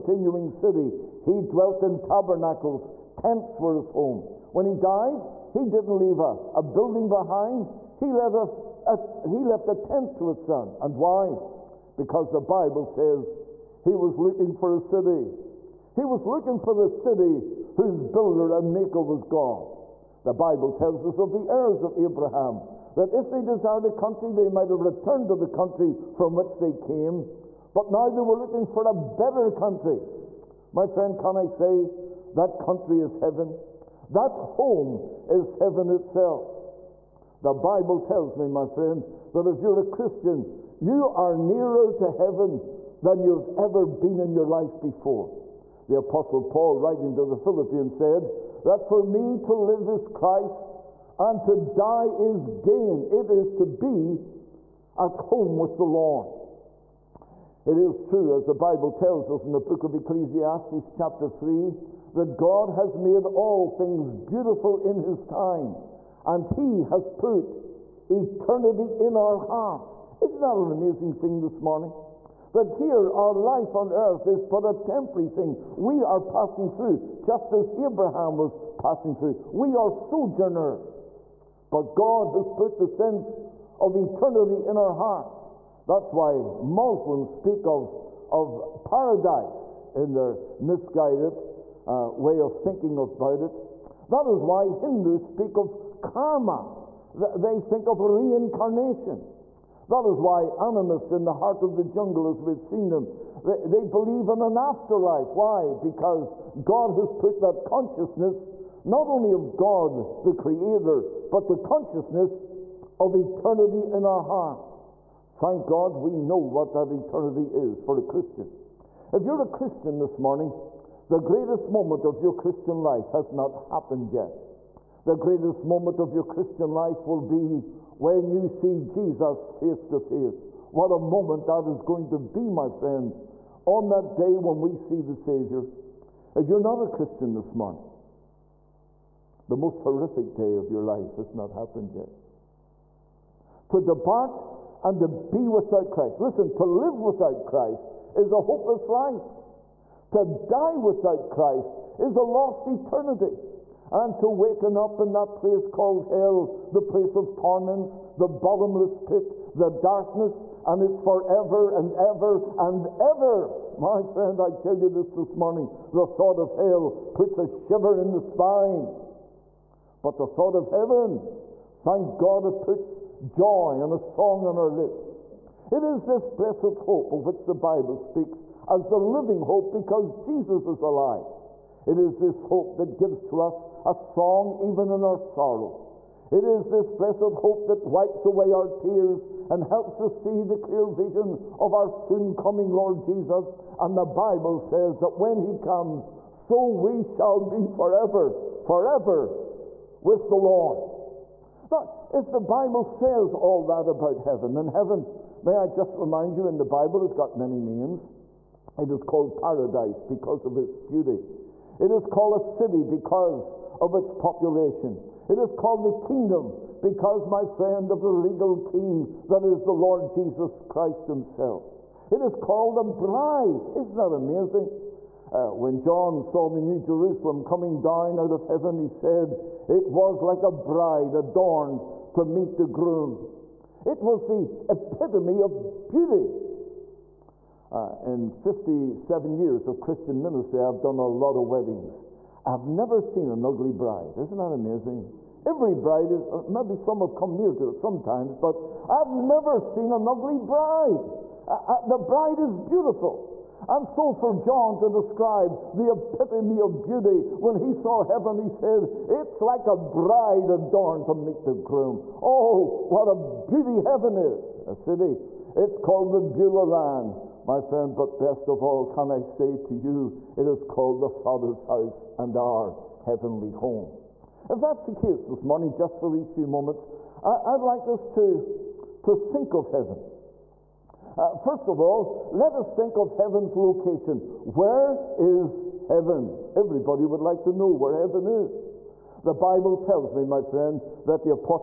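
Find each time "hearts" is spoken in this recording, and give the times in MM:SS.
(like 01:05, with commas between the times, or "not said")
01:09, 01:24, 01:41, 01:54.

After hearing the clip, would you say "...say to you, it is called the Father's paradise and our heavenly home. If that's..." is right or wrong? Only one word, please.
wrong.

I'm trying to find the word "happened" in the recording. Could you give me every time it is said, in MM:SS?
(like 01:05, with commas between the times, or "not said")
02:03, 02:21.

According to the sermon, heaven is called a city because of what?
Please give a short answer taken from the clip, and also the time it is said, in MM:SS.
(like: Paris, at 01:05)
its population, at 03:33.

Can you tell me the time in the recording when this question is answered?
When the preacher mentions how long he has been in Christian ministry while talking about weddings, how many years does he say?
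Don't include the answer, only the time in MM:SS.
03:58.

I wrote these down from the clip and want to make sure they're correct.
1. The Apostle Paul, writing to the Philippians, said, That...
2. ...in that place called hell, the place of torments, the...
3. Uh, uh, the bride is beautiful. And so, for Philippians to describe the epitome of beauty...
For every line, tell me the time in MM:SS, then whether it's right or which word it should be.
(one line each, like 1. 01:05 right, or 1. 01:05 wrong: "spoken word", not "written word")
1. 00:45 right
2. 02:34 right
3. 04:11 wrong: "John", not "Philippians".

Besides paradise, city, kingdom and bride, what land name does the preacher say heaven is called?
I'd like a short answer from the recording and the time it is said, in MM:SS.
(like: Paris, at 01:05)
Beulah land, at 04:26.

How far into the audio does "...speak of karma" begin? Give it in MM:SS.
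01:35.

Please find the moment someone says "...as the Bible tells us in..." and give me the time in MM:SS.
00:58.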